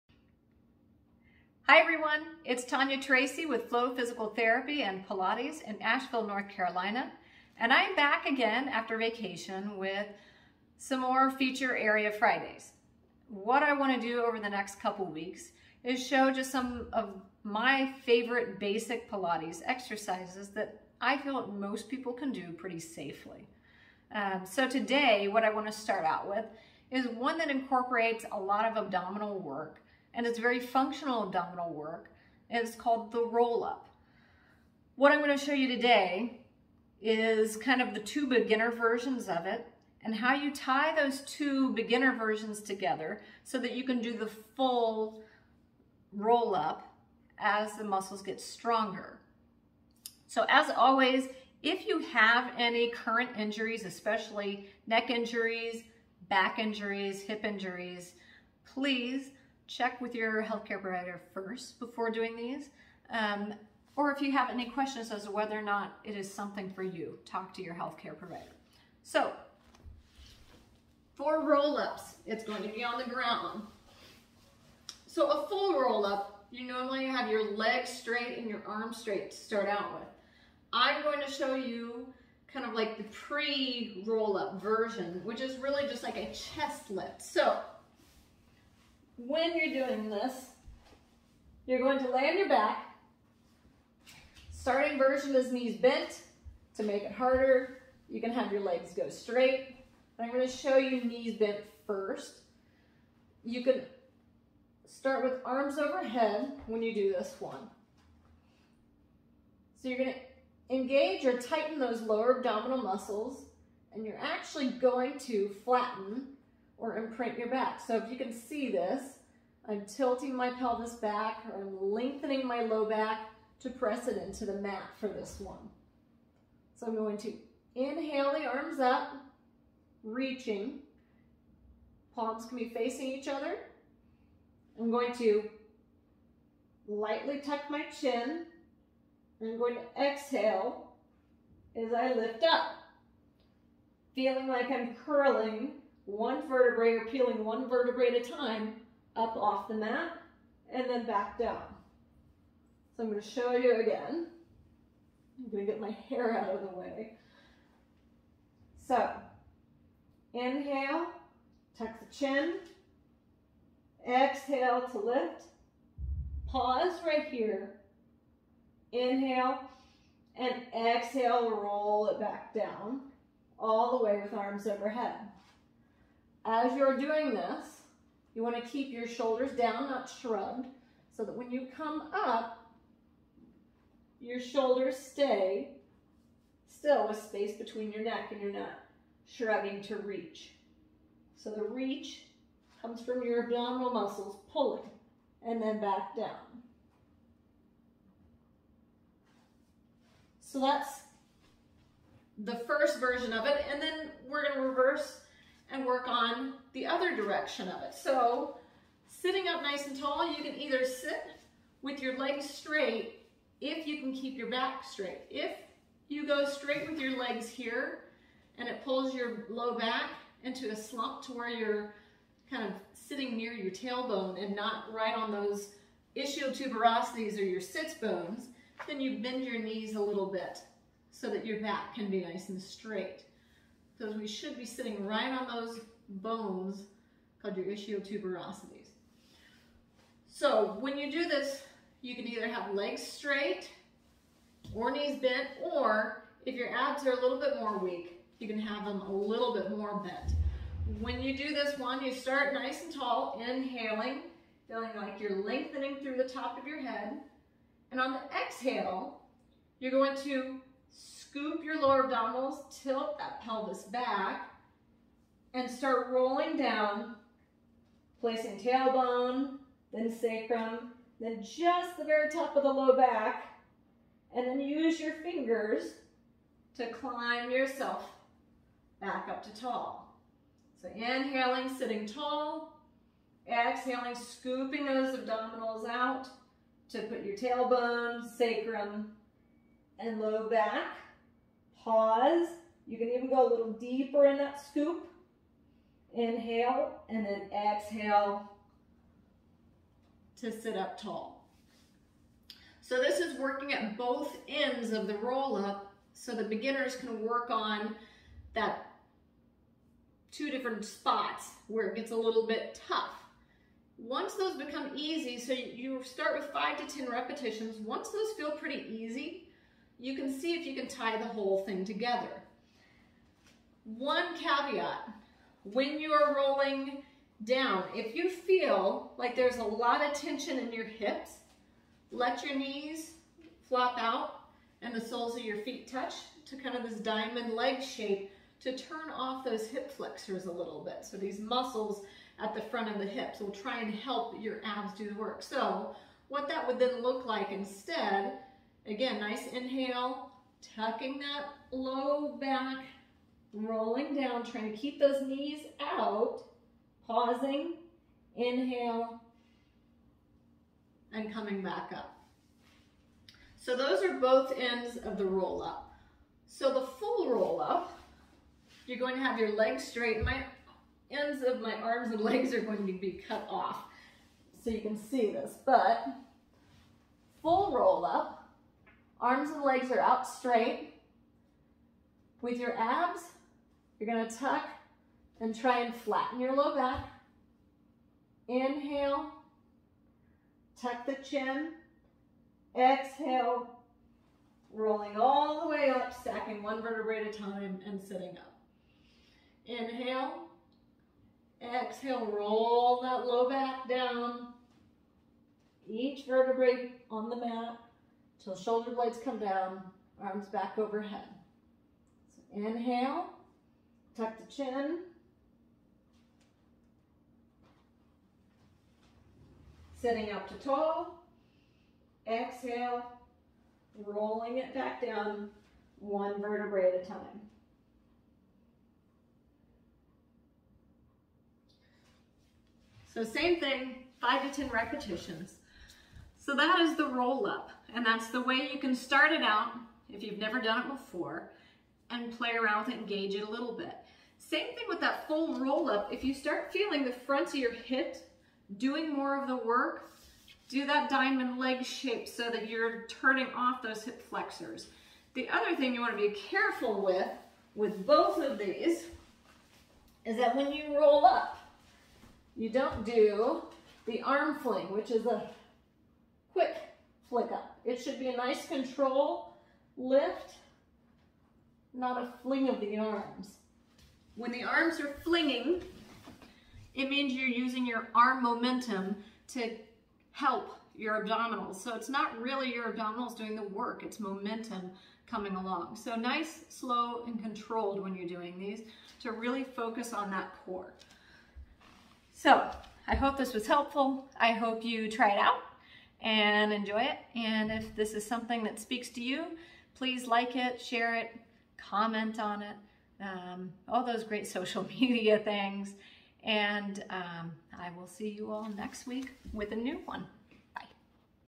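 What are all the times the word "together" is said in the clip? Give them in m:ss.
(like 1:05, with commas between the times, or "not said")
0:42, 5:21.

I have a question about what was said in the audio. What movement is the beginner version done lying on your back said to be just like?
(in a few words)
chest lift.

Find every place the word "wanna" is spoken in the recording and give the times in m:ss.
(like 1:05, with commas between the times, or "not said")
0:13, 0:25.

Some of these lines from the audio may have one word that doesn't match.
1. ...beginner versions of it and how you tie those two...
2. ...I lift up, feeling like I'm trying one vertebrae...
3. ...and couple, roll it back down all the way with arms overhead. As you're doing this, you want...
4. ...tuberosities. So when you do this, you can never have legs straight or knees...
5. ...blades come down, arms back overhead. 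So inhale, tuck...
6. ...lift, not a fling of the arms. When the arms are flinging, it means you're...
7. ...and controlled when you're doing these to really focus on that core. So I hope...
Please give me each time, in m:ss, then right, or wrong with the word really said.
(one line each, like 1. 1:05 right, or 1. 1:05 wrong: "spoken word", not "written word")
1. 0:38 right
2. 2:21 wrong: "curling", not "trying"
3. 2:50 wrong: "exhale", not "couple"
4. 3:57 wrong: "either", not "never"
5. 6:48 right
6. 7:49 right
7. 8:07 right.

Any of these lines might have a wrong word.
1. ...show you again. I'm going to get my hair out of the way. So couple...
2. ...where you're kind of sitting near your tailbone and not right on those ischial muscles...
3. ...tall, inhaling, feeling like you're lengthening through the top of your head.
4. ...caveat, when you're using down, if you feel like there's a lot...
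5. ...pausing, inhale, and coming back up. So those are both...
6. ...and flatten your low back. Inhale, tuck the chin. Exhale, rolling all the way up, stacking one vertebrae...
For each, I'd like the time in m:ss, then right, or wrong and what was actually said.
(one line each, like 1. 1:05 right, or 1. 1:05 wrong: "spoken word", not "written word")
1. 2:33 wrong: "inhale", not "couple"
2. 3:41 wrong: "tuberosities", not "muscles"
3. 4:12 right
4. 5:24 wrong: "rolling", not "using"
5. 5:57 right
6. 6:25 right.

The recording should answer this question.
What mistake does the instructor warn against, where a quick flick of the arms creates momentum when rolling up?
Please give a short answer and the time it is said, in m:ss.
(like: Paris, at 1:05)
arm fling, at 7:44.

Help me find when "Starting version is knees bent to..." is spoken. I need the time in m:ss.
1:34.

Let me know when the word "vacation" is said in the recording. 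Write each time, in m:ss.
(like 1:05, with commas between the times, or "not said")
0:08.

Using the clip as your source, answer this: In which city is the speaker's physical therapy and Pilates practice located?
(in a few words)
Asheville.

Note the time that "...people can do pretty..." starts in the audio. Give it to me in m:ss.
0:21.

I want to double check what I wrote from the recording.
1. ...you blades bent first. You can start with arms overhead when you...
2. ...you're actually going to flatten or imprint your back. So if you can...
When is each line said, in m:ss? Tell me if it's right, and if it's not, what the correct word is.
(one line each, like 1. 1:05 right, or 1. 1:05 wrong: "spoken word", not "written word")
1. 1:40 wrong: "knees", not "blades"
2. 1:54 right.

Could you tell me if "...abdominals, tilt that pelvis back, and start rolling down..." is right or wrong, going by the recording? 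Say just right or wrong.
right.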